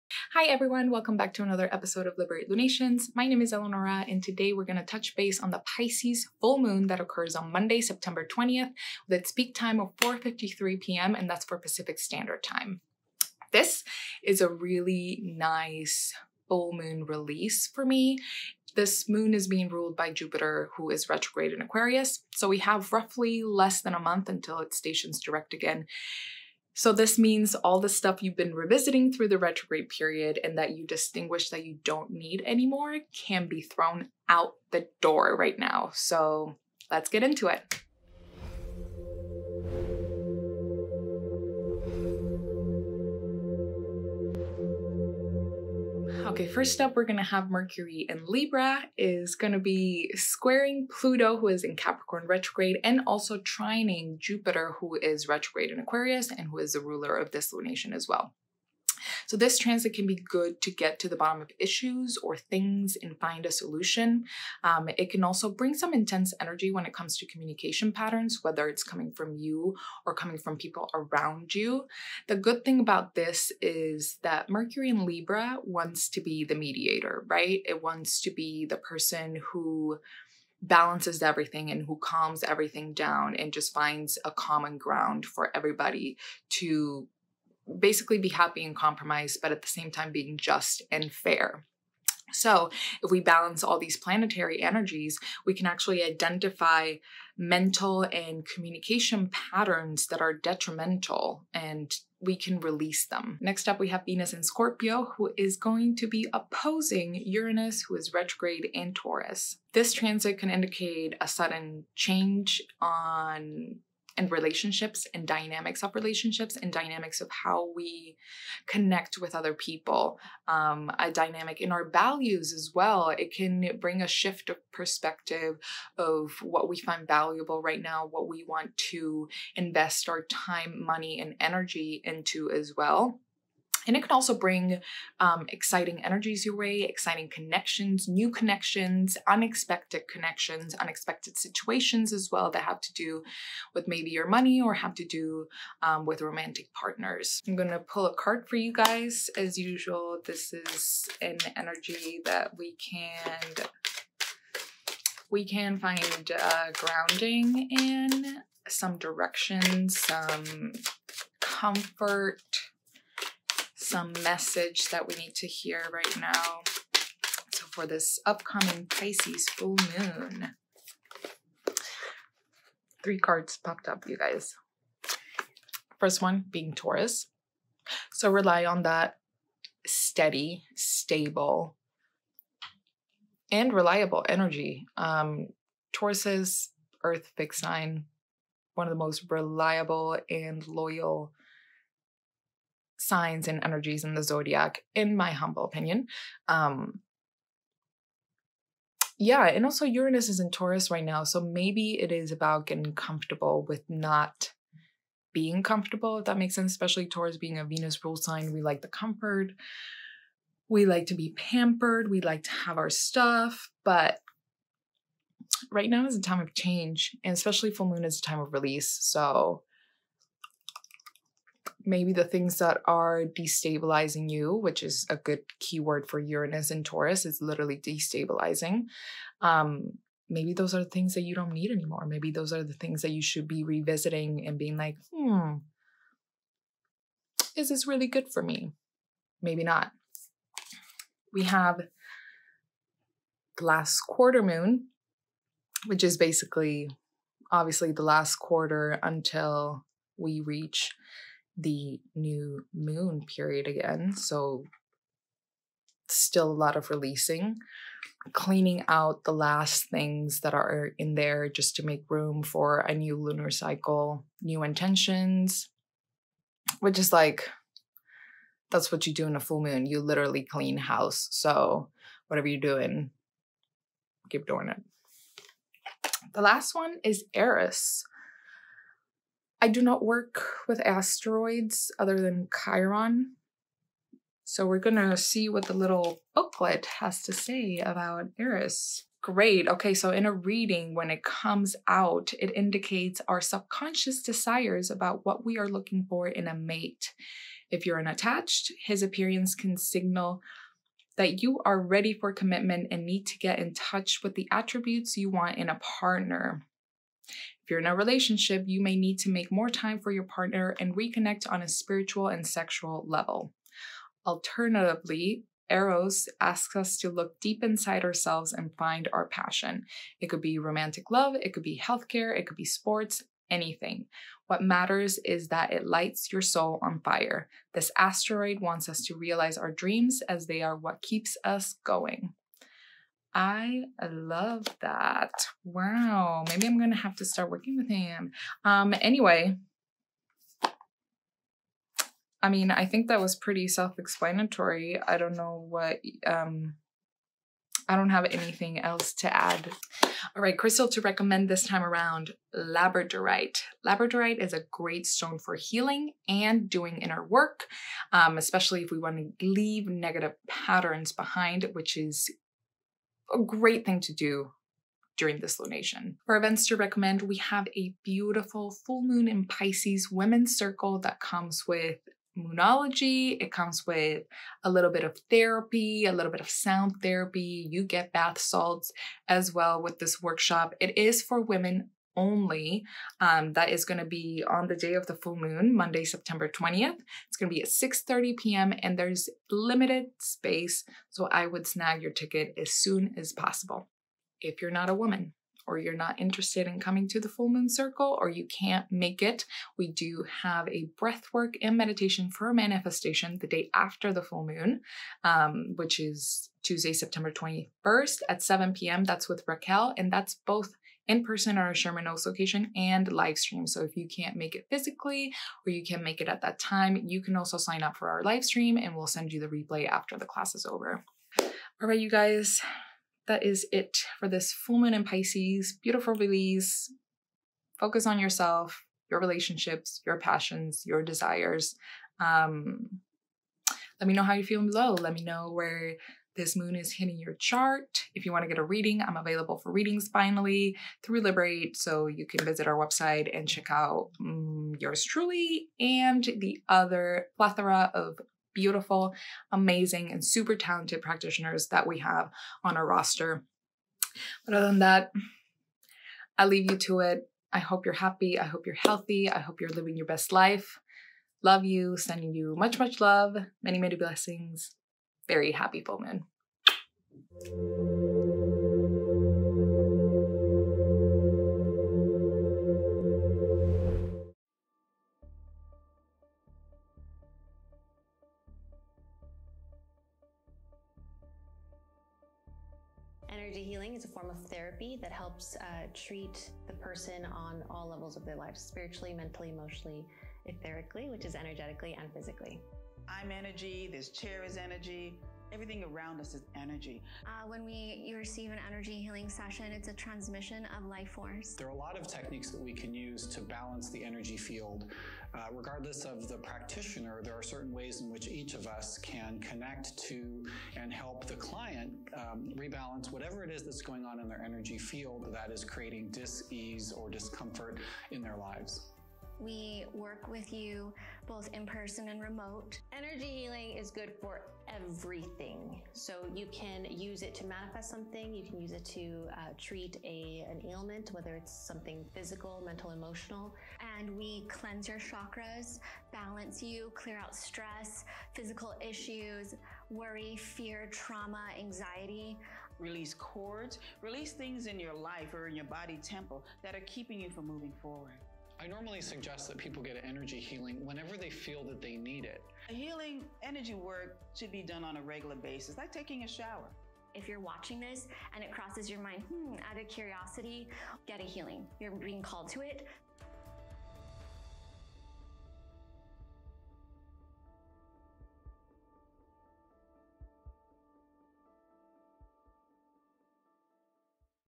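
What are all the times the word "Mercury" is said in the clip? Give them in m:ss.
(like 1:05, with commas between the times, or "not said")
0:47, 1:14.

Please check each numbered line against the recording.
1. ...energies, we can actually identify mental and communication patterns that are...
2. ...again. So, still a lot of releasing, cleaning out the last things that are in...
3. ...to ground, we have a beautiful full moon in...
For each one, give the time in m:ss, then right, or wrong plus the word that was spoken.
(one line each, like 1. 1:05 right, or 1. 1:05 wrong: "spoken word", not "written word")
1. 1:34 right
2. 4:13 right
3. 6:06 wrong: "recommend", not "ground".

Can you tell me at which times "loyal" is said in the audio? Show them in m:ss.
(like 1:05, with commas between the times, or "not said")
3:10.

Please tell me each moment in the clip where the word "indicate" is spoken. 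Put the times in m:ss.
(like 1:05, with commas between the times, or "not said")
1:50, 4:52.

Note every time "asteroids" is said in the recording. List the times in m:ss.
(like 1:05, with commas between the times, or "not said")
4:40, 5:27.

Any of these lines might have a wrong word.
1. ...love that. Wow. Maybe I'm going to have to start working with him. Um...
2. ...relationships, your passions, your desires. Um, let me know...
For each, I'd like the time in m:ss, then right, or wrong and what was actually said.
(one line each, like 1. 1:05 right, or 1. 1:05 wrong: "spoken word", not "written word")
1. 5:34 right
2. 7:09 right.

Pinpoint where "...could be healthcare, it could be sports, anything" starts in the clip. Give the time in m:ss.
5:21.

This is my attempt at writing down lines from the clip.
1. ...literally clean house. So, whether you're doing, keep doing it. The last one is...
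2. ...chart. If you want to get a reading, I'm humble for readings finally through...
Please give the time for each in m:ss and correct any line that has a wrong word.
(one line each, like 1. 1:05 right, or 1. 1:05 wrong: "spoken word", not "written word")
1. 4:30 wrong: "whatever", not "whether"
2. 7:17 wrong: "available", not "humble".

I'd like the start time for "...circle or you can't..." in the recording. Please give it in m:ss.
6:37.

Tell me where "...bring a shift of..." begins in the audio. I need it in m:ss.
2:03.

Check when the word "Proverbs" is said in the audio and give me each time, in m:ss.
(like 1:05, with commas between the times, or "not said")
not said.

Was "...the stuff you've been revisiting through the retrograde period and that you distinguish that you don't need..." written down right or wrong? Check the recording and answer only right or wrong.
right.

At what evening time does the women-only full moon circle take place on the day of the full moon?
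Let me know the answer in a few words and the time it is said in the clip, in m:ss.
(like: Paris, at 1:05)
6:30 p.m., at 6:27.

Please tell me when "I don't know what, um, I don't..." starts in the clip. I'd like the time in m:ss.
5:45.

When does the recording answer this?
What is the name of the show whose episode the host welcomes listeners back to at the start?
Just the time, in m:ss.
0:02.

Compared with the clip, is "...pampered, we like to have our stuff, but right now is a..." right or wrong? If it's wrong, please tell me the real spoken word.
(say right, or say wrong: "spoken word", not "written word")
right.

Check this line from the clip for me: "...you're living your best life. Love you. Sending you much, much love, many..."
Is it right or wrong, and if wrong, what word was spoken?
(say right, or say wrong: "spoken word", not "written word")
right.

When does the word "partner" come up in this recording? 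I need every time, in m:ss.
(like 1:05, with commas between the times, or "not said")
2:26, 5:05, 5:10.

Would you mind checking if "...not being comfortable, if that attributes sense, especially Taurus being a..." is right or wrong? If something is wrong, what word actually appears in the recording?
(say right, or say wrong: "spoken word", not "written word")
wrong: "makes", not "attributes".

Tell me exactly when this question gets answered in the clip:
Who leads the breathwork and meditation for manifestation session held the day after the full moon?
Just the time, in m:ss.
6:49.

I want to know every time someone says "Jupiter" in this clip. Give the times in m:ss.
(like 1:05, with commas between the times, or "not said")
0:20, 0:54.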